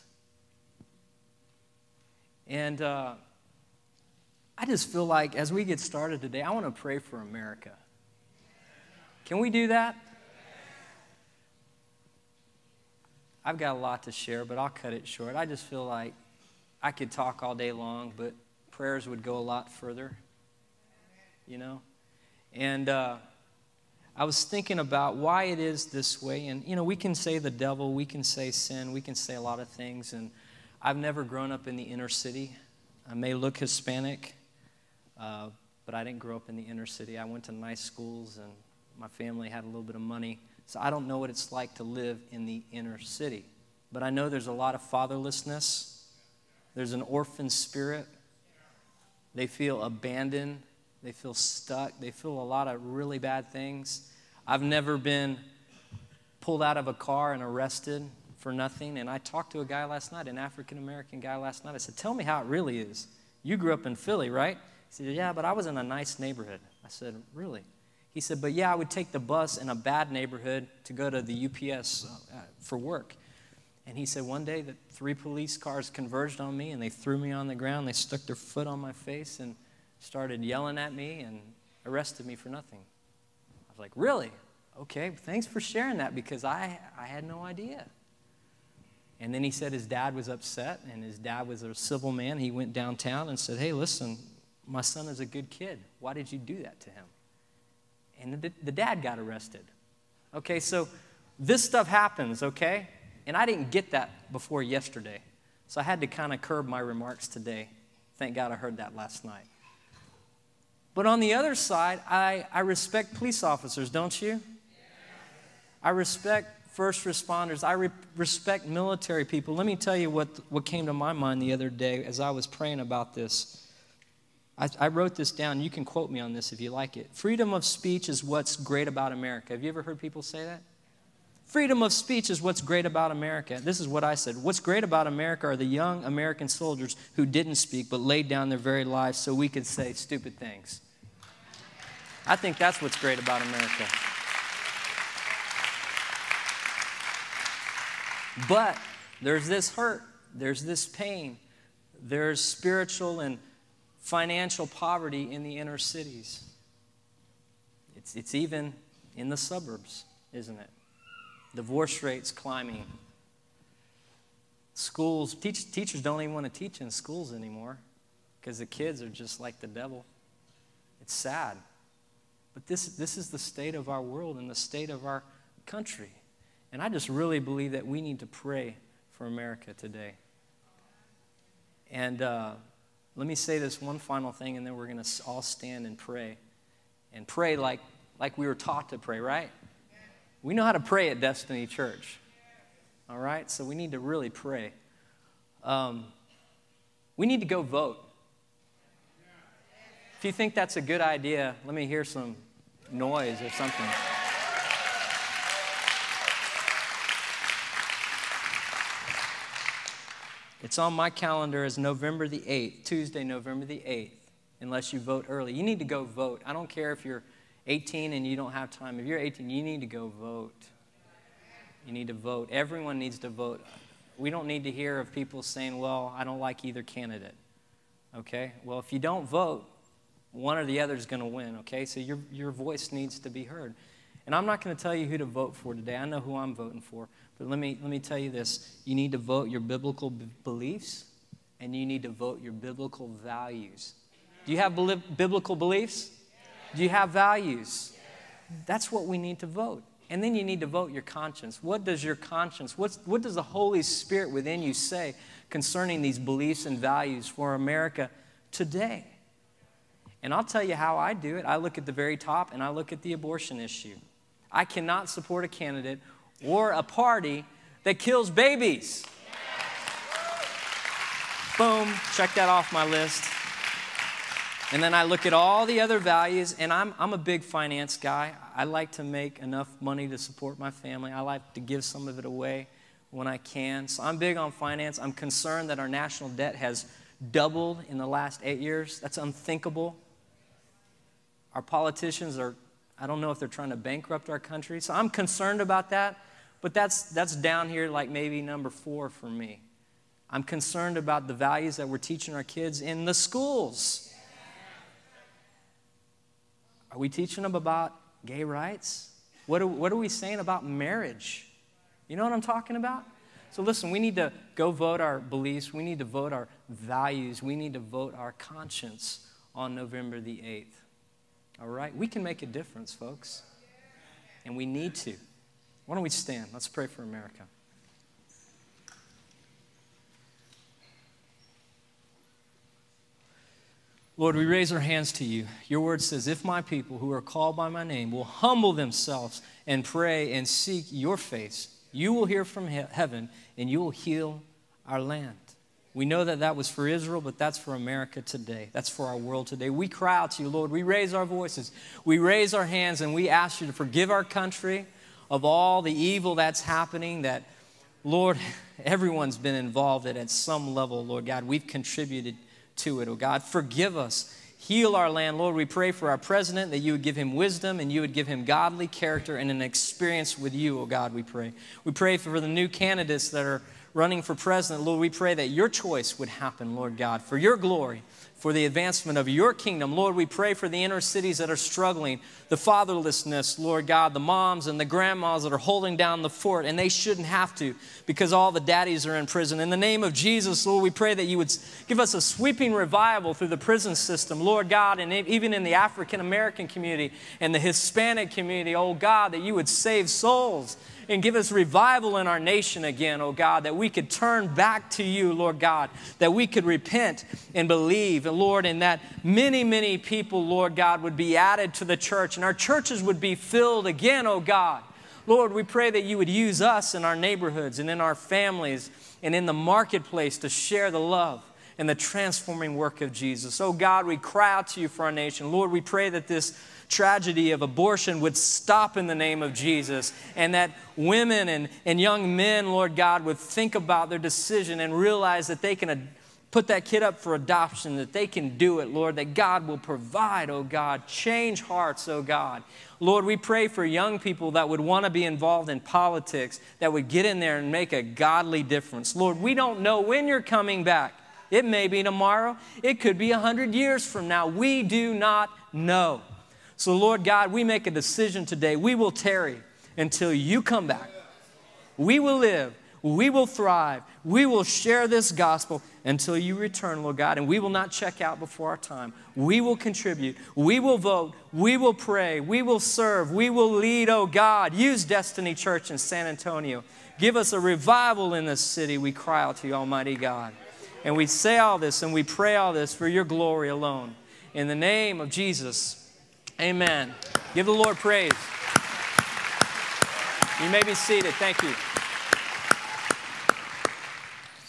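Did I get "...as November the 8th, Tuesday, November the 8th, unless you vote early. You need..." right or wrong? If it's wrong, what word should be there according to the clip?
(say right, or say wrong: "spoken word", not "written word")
right.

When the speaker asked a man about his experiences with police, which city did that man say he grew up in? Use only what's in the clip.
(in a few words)
Philly.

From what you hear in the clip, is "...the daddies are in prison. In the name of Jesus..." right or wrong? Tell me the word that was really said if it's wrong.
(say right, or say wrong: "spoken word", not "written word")
right.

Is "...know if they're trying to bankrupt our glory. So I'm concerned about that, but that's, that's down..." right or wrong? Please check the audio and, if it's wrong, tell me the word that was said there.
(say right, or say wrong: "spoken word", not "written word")
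wrong: "country", not "glory".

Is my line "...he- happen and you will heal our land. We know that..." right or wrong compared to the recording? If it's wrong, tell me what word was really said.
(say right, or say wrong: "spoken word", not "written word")
wrong: "heaven", not "happen".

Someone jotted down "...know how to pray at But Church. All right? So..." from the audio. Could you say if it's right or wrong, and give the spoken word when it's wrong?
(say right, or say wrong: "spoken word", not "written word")
wrong: "Destiny", not "But".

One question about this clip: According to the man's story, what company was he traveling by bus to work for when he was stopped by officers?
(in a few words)
UPS.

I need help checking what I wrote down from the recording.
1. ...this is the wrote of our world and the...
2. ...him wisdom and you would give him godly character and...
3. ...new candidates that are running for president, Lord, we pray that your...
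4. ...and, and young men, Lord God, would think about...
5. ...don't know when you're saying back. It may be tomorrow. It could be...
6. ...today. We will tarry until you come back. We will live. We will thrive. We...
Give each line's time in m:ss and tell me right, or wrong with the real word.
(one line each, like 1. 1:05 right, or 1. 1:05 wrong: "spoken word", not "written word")
1. 2:52 wrong: "state", not "wrote"
2. 6:07 right
3. 6:12 right
4. 7:11 right
5. 7:29 wrong: "coming", not "saying"
6. 7:38 right.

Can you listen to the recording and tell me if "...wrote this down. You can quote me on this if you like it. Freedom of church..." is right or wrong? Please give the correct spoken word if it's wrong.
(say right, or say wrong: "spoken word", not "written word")
wrong: "speech", not "church".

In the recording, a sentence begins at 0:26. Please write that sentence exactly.
And, you know, we can say the devil, we can say sin, we can say a lot of things.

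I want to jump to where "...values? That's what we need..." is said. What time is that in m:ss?
4:07.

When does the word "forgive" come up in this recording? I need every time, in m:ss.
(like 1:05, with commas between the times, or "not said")
5:53, 6:03.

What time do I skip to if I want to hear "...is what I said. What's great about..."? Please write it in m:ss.
2:13.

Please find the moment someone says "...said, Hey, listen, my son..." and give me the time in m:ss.
1:33.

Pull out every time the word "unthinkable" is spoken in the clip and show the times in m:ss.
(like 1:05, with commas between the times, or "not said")
4:49.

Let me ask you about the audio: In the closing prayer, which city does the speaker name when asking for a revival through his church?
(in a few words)
San Antonio.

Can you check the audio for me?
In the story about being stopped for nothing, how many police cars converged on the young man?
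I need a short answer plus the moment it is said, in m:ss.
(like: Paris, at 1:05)
3, at 1:14.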